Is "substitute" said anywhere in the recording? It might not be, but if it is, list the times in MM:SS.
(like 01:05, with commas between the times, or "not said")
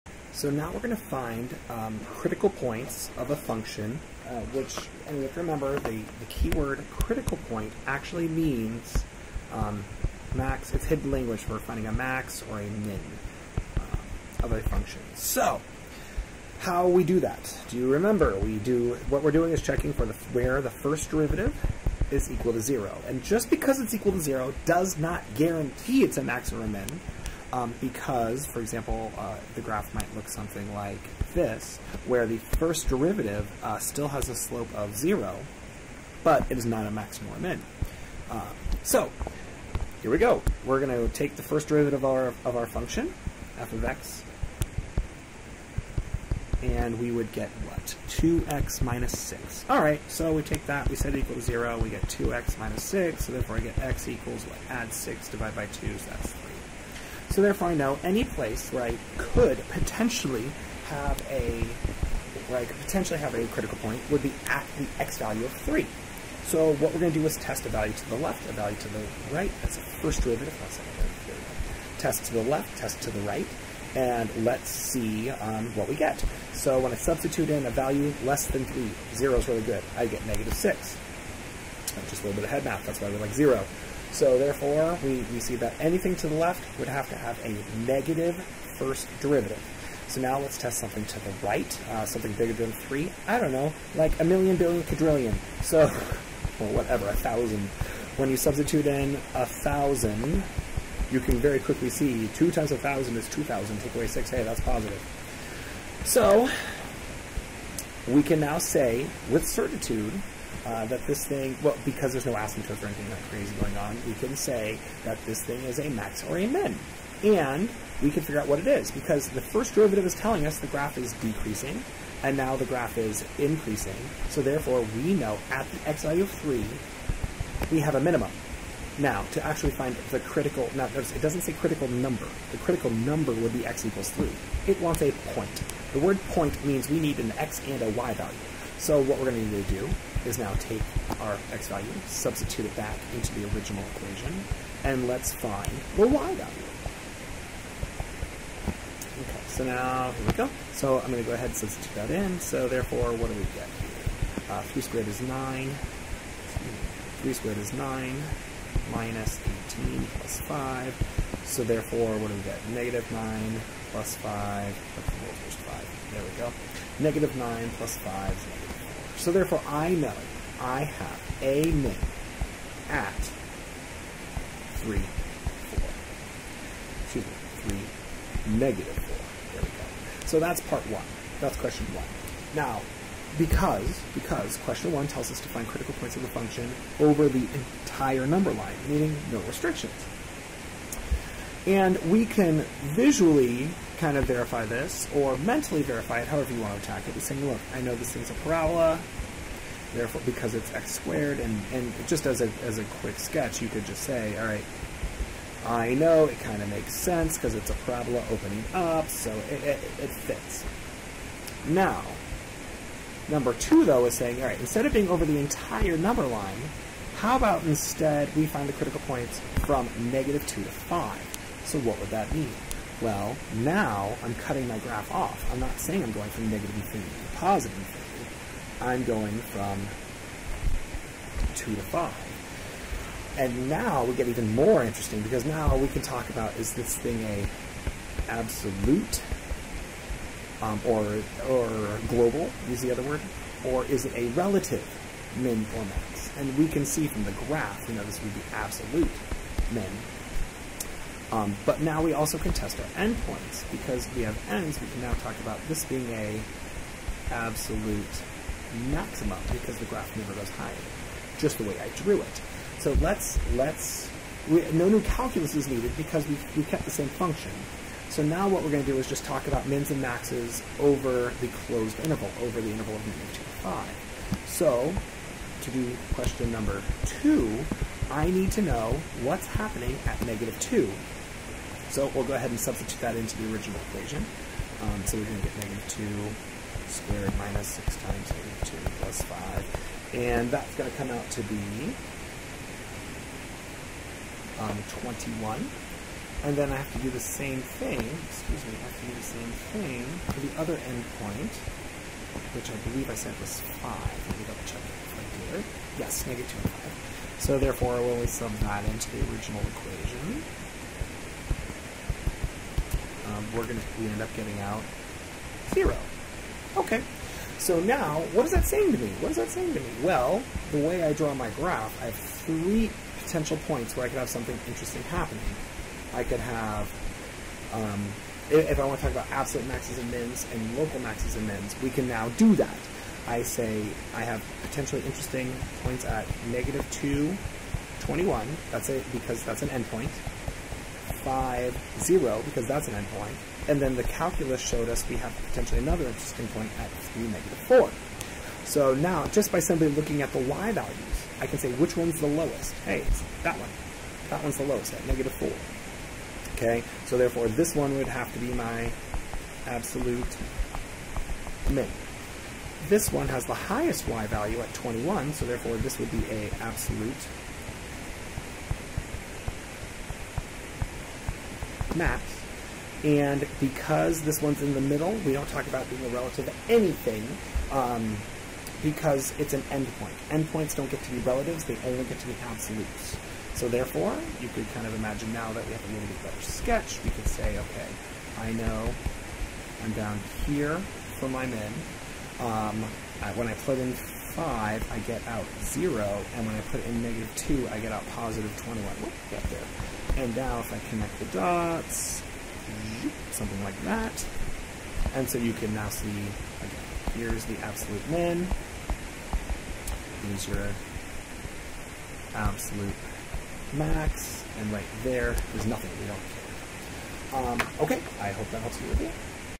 01:16, 01:38, 02:22, 02:31, 04:42.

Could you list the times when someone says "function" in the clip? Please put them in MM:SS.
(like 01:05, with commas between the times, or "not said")
00:03, 00:14, 00:42, 03:06, 04:27.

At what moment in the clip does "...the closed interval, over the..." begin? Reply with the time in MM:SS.
04:31.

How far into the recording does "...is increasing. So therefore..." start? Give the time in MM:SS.
02:02.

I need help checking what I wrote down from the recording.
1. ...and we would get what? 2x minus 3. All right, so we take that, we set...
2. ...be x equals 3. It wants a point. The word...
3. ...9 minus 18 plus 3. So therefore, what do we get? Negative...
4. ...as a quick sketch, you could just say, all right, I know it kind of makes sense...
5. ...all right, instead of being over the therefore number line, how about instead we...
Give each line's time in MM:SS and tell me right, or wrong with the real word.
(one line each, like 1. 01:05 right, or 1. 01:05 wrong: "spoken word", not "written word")
1. 00:46 wrong: "6", not "3"
2. 02:13 right
3. 02:37 wrong: "5", not "3"
4. 03:22 right
5. 03:34 wrong: "entire", not "therefore".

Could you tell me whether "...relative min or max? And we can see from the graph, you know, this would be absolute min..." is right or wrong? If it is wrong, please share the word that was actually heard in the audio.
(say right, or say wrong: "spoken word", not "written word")
right.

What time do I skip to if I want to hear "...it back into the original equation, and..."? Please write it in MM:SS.
02:22.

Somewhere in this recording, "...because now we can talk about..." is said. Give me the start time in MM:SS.
03:55.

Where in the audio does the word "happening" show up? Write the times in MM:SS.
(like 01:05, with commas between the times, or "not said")
04:39, 05:25.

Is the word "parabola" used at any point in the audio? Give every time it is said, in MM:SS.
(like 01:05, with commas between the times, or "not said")
03:18, 03:27.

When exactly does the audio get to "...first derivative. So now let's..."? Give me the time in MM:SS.
01:28.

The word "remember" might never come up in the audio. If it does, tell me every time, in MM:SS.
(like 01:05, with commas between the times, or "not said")
00:05, 00:17.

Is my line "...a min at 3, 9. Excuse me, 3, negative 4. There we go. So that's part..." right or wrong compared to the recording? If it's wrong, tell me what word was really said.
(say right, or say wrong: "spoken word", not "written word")
wrong: "4", not "9".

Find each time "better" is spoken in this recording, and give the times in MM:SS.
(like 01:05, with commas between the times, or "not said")
06:26.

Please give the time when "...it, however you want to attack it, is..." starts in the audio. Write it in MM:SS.
03:16.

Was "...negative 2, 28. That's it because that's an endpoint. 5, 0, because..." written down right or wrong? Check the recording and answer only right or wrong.
wrong.